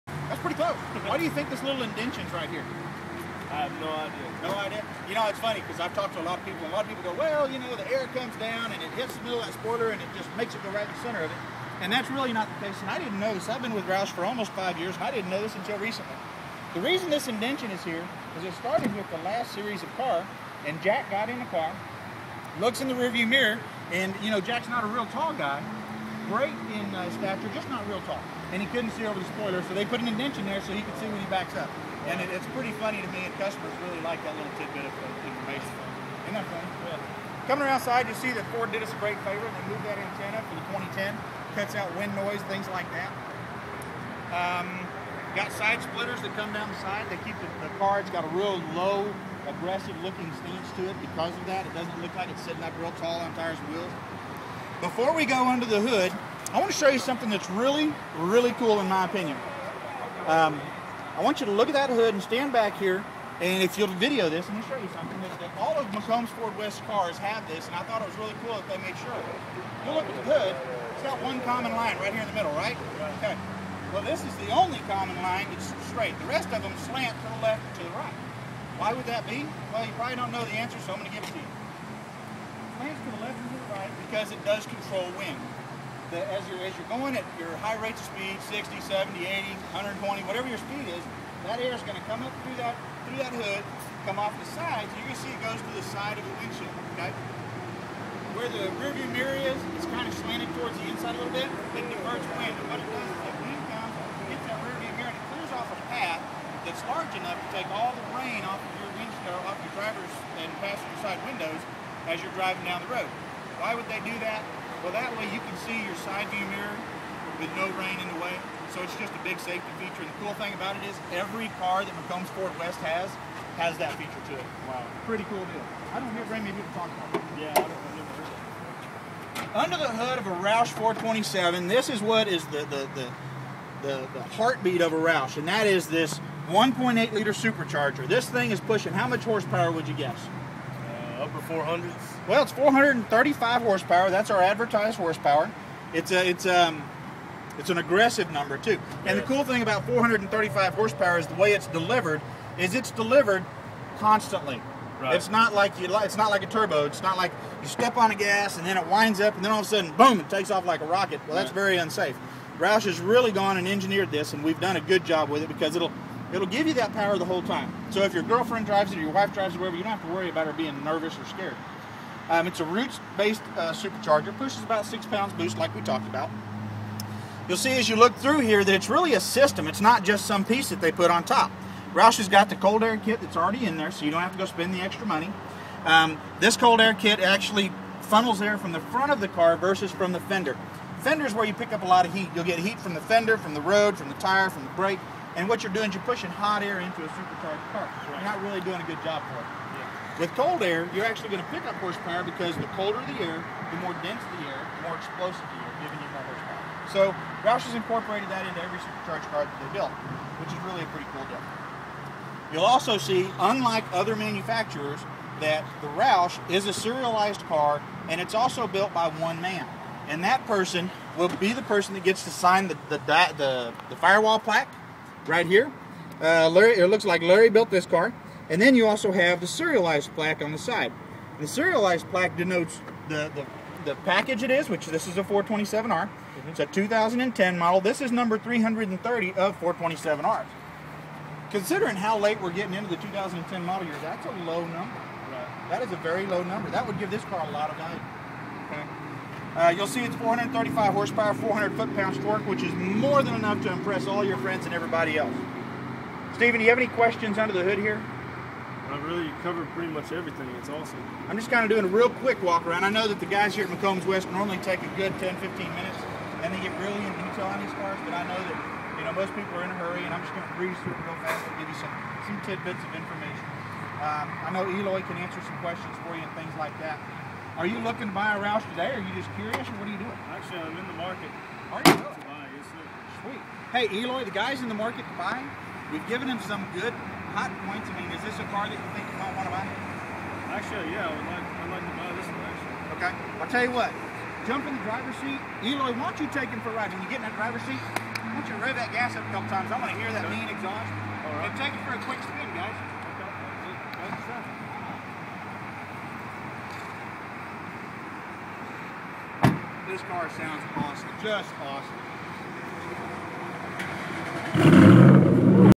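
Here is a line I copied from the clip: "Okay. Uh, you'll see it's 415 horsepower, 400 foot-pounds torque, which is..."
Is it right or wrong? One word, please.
wrong.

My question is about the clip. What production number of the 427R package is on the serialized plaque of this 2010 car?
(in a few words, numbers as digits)
330.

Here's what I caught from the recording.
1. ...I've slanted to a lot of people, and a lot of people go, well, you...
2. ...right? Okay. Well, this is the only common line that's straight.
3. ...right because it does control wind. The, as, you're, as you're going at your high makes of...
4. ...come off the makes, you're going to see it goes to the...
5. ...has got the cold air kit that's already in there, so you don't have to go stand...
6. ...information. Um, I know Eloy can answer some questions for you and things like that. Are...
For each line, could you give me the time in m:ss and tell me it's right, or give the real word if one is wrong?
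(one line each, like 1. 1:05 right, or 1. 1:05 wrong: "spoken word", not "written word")
1. 0:05 wrong: "talked", not "slanted"
2. 1:12 right
3. 1:23 wrong: "rates", not "makes"
4. 1:34 wrong: "sides", not "makes"
5. 3:02 wrong: "spend", not "stand"
6. 4:32 right.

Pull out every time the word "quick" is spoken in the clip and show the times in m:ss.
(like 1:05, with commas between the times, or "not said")
4:22, 5:02.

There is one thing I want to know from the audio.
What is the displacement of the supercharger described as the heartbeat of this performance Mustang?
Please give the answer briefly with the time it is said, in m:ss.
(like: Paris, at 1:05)
1.8 liter, at 2:16.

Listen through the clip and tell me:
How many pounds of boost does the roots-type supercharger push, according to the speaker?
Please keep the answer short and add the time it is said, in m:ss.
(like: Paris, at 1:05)
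6, at 2:54.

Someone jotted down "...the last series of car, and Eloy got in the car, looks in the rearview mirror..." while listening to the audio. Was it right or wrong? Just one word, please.
wrong.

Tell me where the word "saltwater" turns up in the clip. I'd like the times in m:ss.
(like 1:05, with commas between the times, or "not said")
not said.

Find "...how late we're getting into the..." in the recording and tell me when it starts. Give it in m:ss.
4:01.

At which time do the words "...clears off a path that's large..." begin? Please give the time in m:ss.
1:45.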